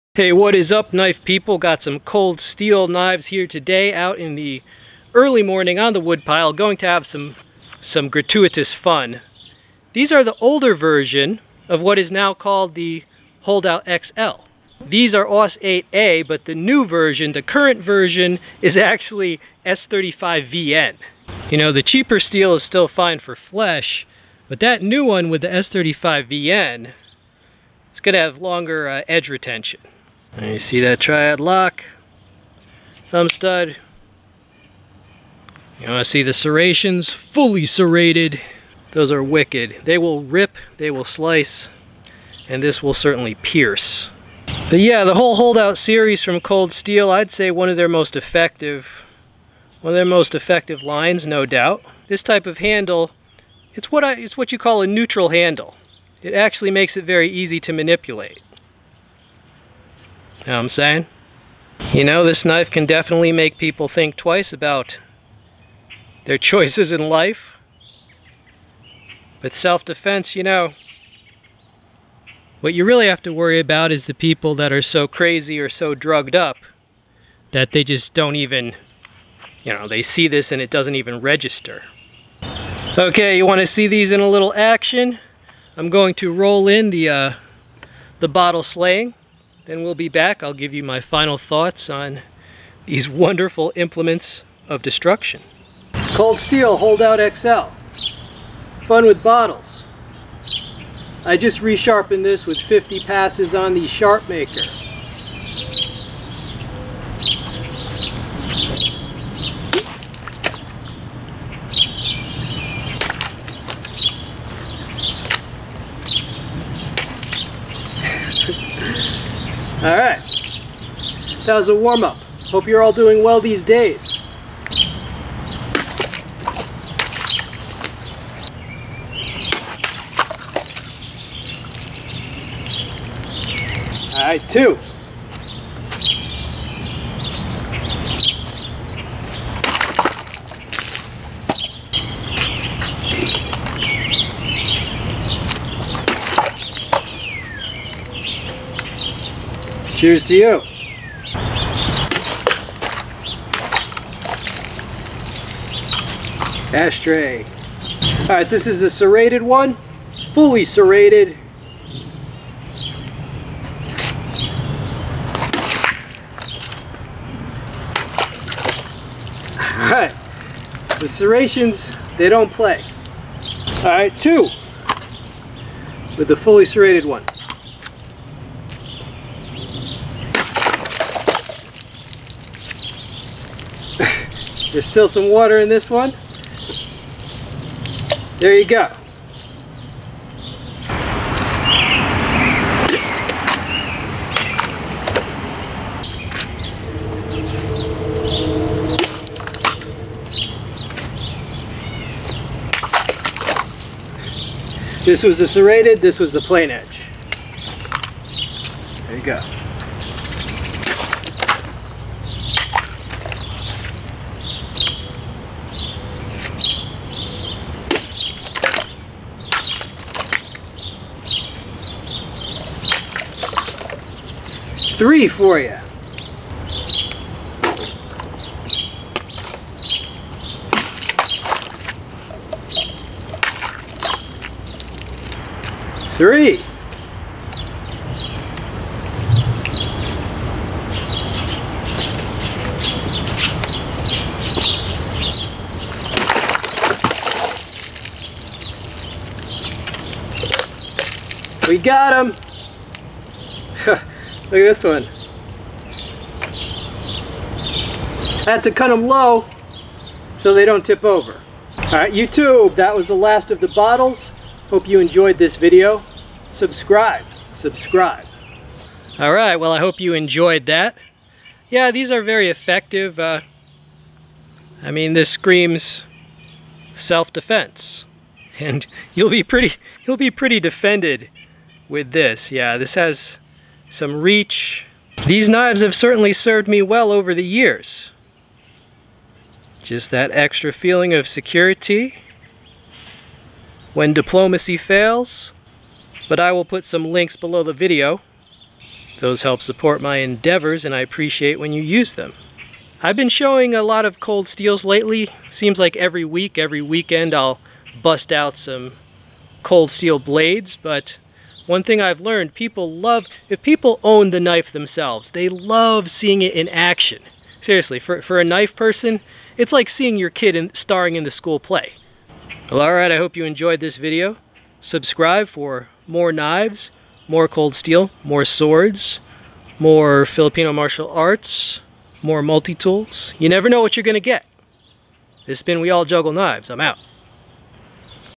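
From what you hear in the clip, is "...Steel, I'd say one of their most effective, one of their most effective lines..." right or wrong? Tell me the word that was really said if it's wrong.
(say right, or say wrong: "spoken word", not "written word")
right.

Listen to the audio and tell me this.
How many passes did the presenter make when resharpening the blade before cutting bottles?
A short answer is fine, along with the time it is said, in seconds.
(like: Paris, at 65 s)
50, at 102 s.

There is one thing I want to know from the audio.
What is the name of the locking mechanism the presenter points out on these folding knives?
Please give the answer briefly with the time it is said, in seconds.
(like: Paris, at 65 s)
Tri-Ad lock, at 30 s.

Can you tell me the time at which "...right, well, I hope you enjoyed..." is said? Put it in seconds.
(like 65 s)
269 s.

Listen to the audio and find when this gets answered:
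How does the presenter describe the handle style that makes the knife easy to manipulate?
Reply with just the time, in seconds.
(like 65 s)
54 s.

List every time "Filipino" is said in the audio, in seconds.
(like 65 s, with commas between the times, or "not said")
330 s.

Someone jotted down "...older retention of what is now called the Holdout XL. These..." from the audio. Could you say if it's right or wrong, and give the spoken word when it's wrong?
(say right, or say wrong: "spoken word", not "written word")
wrong: "version", not "retention".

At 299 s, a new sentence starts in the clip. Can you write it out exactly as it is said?
Those help support my endeavors and I appreciate when you use them.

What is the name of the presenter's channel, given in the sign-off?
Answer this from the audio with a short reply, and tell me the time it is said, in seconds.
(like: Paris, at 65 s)
We All Juggle Knives, at 335 s.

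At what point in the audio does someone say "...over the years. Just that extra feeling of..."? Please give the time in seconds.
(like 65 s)
287 s.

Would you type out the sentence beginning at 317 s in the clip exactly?
Seriously, for, for a knife person, it's like seeing your kid in, starring in the school play.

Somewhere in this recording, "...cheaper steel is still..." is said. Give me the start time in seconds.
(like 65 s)
21 s.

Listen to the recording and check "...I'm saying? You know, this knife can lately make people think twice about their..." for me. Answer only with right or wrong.
wrong.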